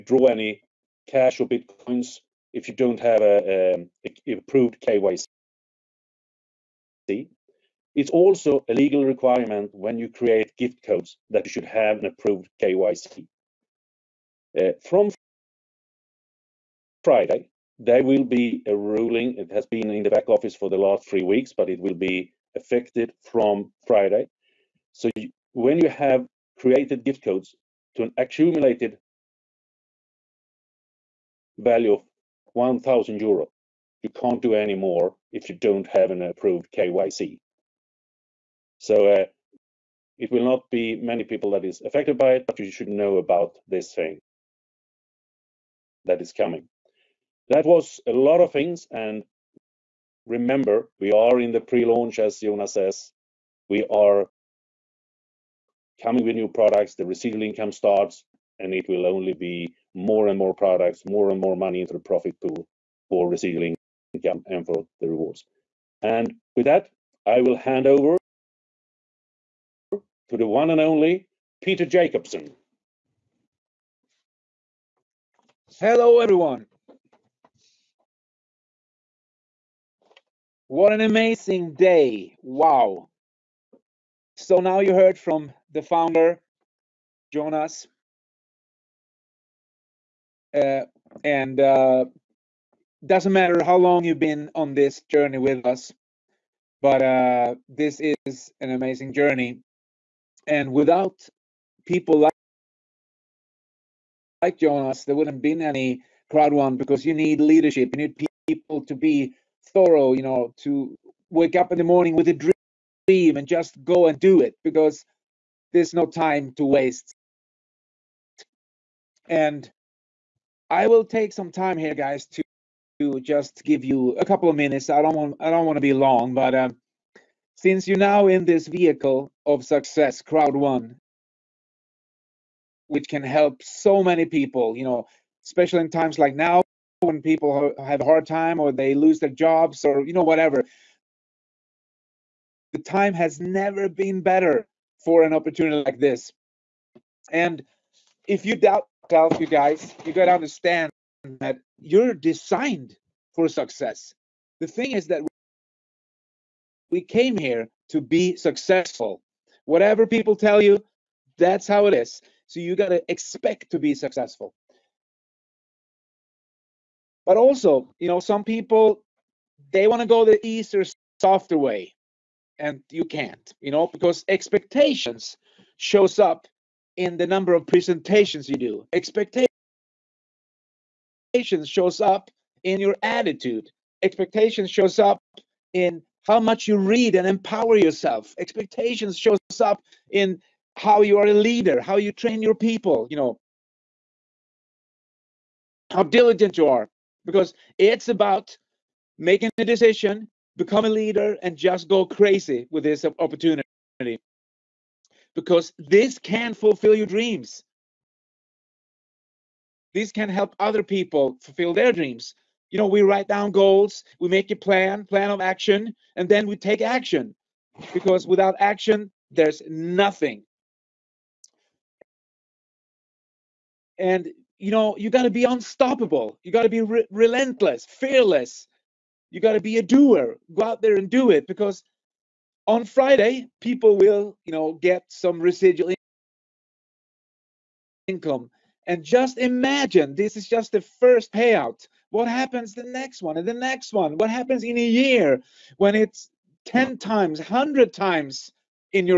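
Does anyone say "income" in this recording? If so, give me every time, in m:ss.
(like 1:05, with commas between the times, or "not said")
0:57, 1:04, 3:58.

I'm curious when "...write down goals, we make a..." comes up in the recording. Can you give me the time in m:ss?
3:33.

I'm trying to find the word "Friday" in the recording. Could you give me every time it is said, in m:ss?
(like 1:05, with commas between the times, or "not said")
0:17, 0:23, 3:52.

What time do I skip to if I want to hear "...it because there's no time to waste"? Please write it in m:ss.
1:54.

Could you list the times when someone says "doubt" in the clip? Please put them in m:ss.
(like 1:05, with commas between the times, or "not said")
2:28.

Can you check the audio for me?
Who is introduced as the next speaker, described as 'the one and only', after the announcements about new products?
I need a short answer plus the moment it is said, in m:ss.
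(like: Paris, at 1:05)
Peter Jacobson, at 1:11.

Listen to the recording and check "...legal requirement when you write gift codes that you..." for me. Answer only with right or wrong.
wrong.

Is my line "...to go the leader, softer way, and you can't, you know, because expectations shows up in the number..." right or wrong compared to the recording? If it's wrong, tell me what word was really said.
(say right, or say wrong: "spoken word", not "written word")
wrong: "easier", not "leader".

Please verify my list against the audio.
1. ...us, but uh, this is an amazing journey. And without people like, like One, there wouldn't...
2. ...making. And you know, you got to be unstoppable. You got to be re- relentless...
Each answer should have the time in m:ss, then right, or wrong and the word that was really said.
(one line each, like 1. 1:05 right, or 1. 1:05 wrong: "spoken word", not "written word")
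1. 1:35 wrong: "Jonas", not "One"
2. 3:39 wrong: "nothing", not "making".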